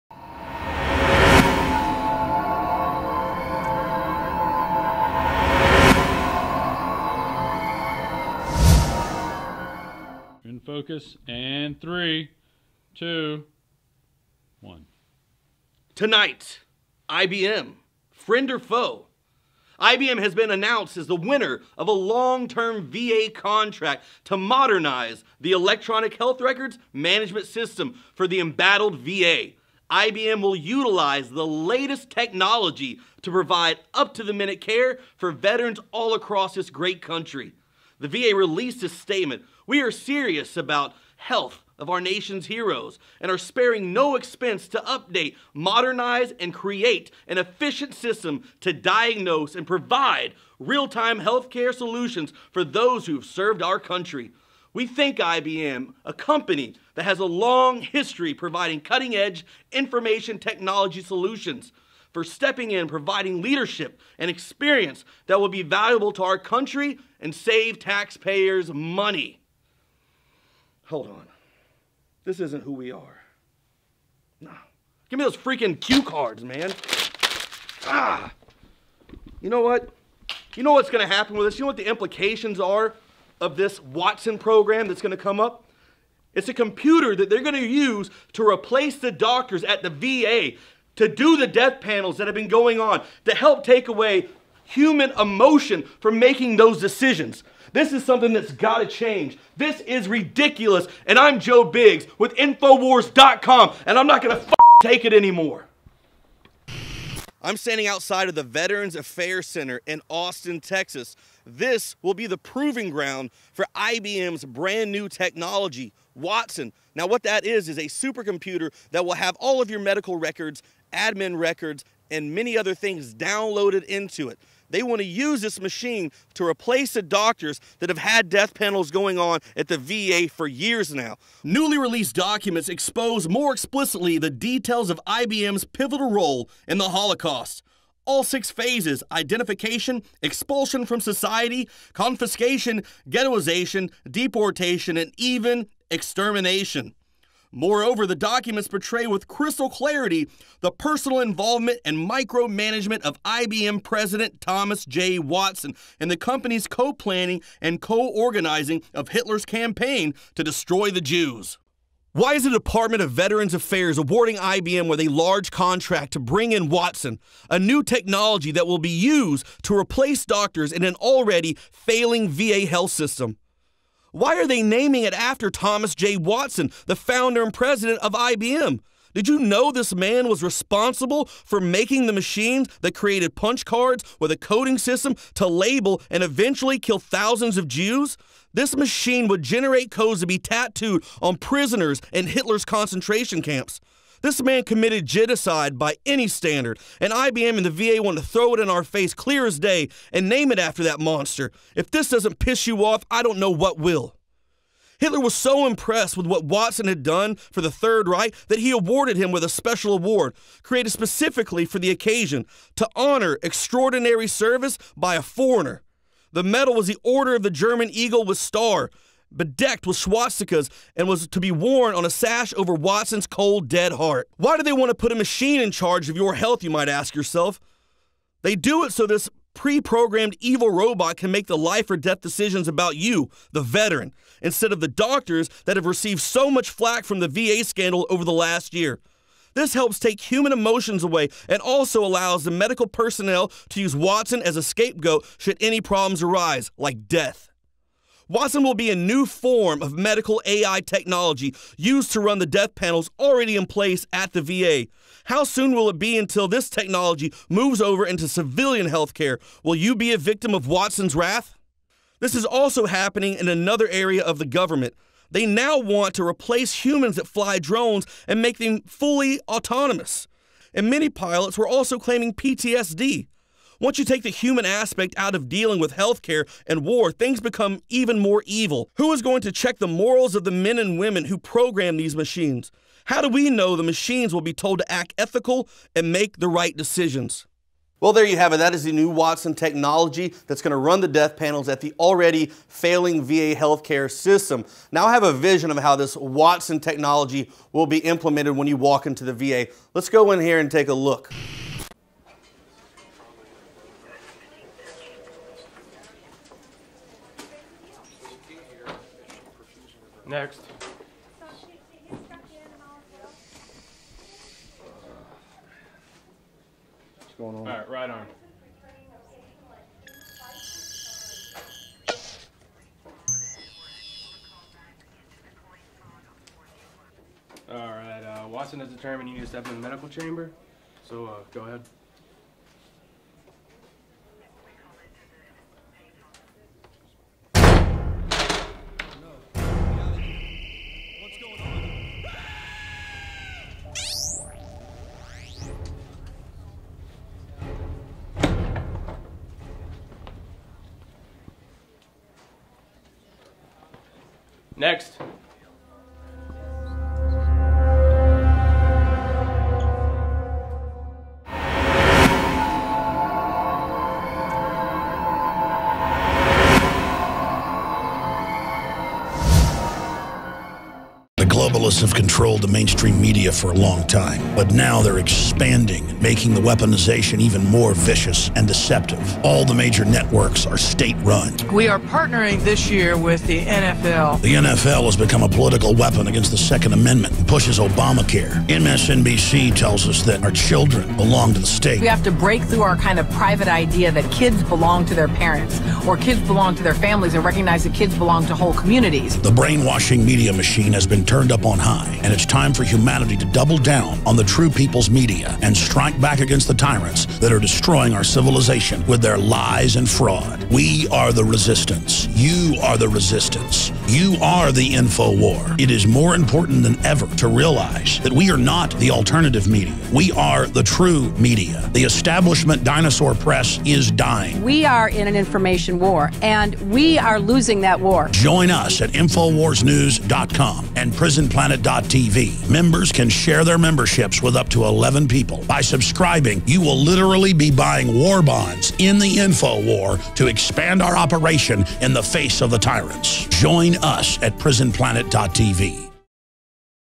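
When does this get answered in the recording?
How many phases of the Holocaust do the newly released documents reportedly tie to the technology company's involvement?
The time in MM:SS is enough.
02:18.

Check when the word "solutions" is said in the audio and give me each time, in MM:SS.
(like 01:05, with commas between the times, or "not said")
00:51, 01:01.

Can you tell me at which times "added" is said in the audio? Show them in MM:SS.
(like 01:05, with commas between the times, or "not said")
not said.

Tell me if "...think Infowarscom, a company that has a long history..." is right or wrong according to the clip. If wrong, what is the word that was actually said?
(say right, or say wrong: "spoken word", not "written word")
wrong: "IBM", not "Infowarscom".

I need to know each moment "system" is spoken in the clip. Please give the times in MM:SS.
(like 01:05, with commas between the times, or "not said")
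00:27, 00:47, 02:52, 03:04, 04:54.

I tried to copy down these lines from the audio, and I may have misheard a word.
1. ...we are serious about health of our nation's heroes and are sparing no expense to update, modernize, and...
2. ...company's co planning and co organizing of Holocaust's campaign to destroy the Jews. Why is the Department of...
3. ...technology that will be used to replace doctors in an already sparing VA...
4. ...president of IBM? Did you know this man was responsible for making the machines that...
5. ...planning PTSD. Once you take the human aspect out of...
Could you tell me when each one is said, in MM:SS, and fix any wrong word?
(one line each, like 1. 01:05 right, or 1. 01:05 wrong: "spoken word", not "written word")
1. 00:39 right
2. 02:36 wrong: "Hitler", not "Holocaust"
3. 02:47 wrong: "failing", not "sparing"
4. 02:57 right
5. 04:31 wrong: "claiming", not "planning".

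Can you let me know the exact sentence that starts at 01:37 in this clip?
This is something that's got to change.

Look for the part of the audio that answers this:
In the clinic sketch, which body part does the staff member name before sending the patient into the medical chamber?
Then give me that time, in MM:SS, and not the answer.
05:17.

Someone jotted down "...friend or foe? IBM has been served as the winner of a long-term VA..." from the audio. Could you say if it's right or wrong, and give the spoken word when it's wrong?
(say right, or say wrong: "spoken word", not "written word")
wrong: "announced", not "served".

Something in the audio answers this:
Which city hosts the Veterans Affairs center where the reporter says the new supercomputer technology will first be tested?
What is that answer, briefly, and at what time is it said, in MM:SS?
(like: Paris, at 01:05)
Austin, Texas, at 01:50.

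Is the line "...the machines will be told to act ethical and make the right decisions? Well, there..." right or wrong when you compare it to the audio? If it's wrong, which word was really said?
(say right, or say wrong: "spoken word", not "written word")
right.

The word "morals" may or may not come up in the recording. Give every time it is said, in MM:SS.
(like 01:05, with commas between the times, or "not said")
04:39.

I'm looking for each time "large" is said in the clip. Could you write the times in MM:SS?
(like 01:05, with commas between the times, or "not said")
02:45.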